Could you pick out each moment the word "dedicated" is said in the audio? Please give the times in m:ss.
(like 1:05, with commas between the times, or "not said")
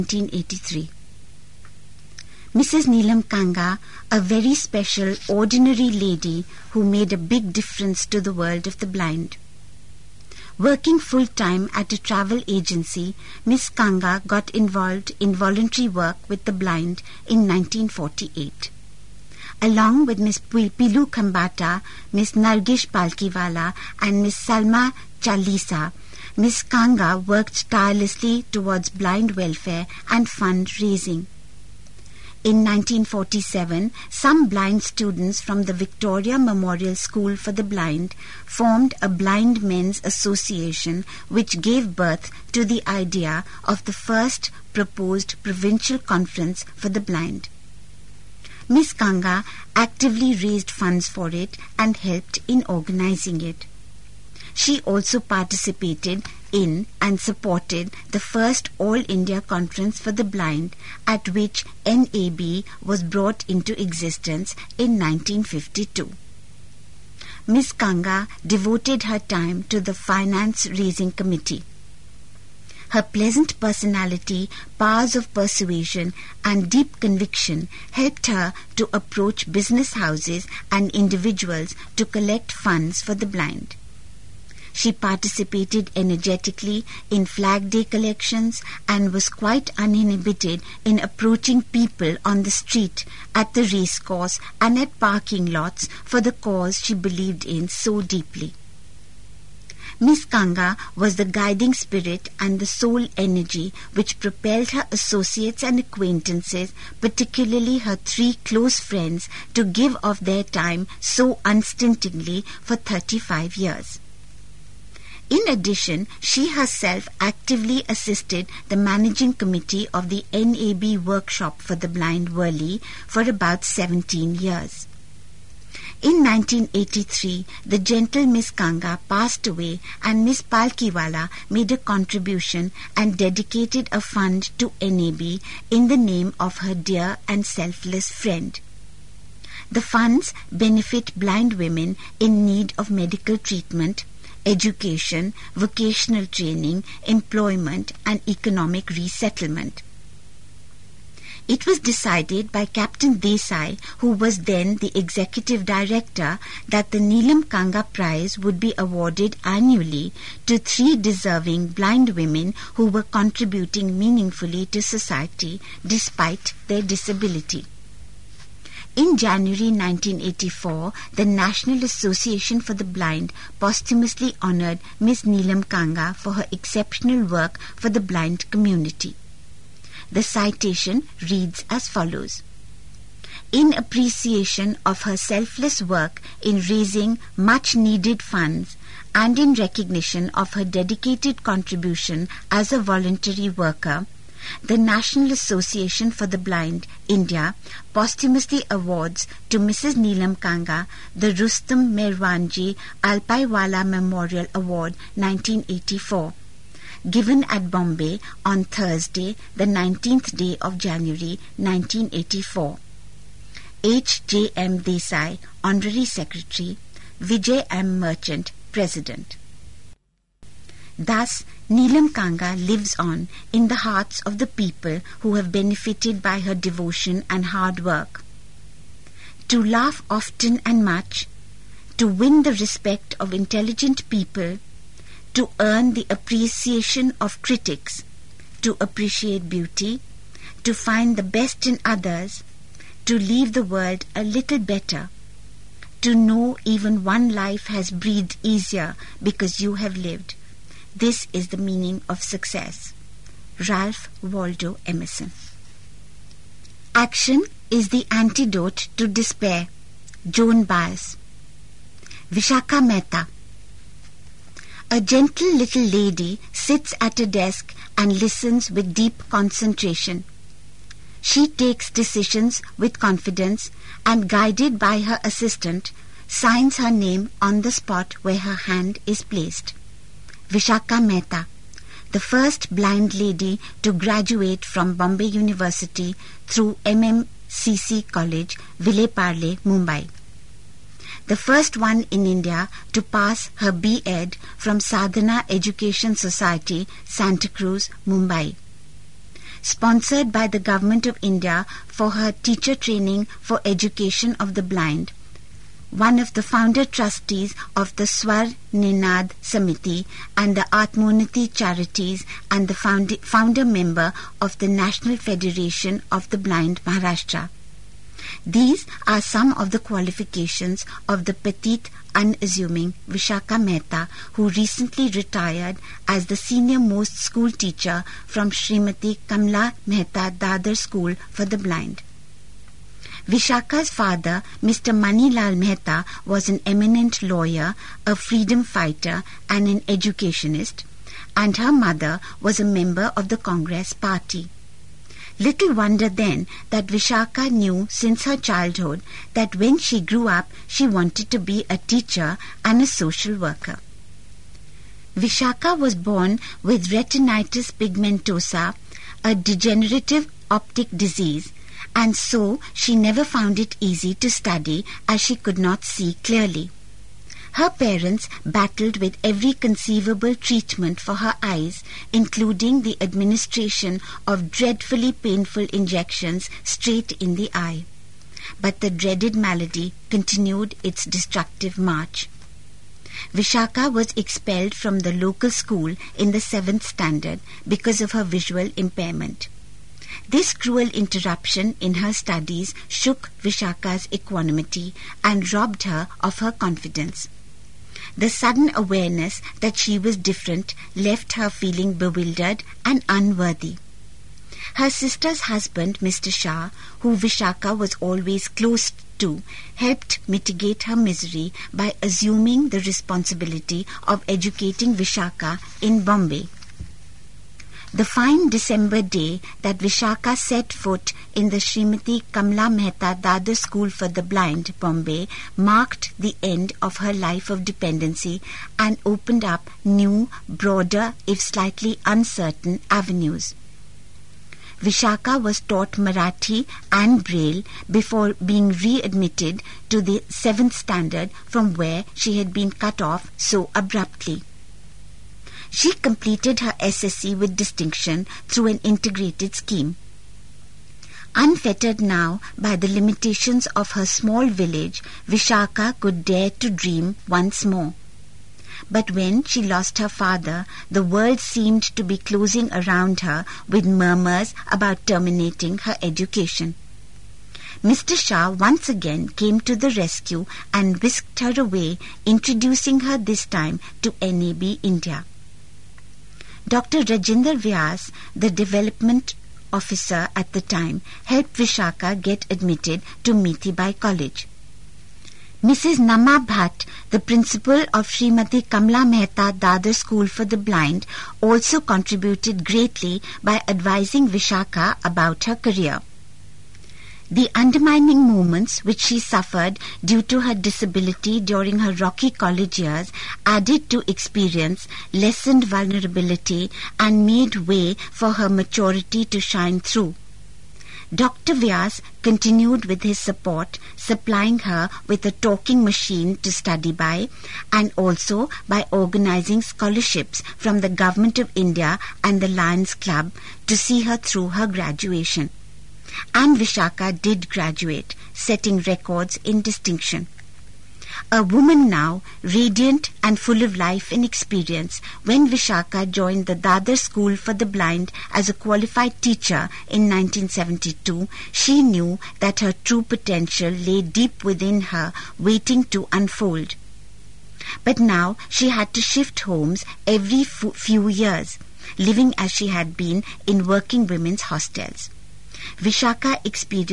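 2:13, 3:10.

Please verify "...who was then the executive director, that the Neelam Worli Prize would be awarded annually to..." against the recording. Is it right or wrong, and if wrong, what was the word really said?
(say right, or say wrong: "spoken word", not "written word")
wrong: "Kanga", not "Worli".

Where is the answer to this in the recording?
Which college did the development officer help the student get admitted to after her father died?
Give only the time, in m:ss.
8:03.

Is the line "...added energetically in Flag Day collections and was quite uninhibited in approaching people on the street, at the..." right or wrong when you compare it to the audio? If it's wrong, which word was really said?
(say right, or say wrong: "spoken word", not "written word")
wrong: "participated", not "added".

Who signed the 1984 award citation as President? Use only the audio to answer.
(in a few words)
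Vijay M. Merchant.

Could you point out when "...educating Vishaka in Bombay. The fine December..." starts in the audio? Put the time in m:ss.
6:54.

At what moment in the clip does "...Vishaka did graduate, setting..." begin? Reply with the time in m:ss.
8:46.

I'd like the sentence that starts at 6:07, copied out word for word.
Her parents battled with every conceivable treatment for her eyes, including the administration of dreadfully painful injections straight in the eye.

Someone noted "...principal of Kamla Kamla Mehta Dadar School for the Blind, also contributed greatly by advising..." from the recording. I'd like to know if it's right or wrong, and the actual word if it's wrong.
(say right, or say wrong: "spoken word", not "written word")
wrong: "Srimati", not "Kamla".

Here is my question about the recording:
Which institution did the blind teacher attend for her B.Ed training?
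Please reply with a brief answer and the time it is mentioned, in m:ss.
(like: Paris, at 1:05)
Sadhana Education Society, at 4:54.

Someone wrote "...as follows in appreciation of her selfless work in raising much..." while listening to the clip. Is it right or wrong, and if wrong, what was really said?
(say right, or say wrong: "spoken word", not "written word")
right.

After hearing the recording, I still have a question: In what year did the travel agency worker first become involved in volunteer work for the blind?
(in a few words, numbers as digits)
1948.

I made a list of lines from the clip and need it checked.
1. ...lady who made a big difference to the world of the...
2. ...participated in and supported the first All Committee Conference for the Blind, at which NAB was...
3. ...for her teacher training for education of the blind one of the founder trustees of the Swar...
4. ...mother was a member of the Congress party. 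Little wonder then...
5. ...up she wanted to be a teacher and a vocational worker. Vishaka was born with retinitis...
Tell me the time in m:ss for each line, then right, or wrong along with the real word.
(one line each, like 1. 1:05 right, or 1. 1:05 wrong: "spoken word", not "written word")
1. 0:05 right
2. 0:55 wrong: "India", not "Committee"
3. 5:01 right
4. 5:41 right
5. 5:50 wrong: "social", not "vocational".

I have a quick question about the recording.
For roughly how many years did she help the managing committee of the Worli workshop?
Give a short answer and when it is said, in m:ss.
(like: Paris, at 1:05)
17, at 2:03.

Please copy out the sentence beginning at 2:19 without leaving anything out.
The funds benefit blind women in need of medical treatment education, vocational training, employment, and economic resettlement.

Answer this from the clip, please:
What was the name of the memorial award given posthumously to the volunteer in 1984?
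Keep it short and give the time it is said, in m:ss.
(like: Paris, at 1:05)
Rustam Merwanji Alpaiwala Memorial Award, at 3:21.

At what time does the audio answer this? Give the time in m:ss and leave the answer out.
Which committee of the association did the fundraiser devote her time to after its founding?
1:09.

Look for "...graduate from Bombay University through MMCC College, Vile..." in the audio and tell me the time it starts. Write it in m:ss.
4:43.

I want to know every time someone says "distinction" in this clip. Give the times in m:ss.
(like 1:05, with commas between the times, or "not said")
7:27, 8:49.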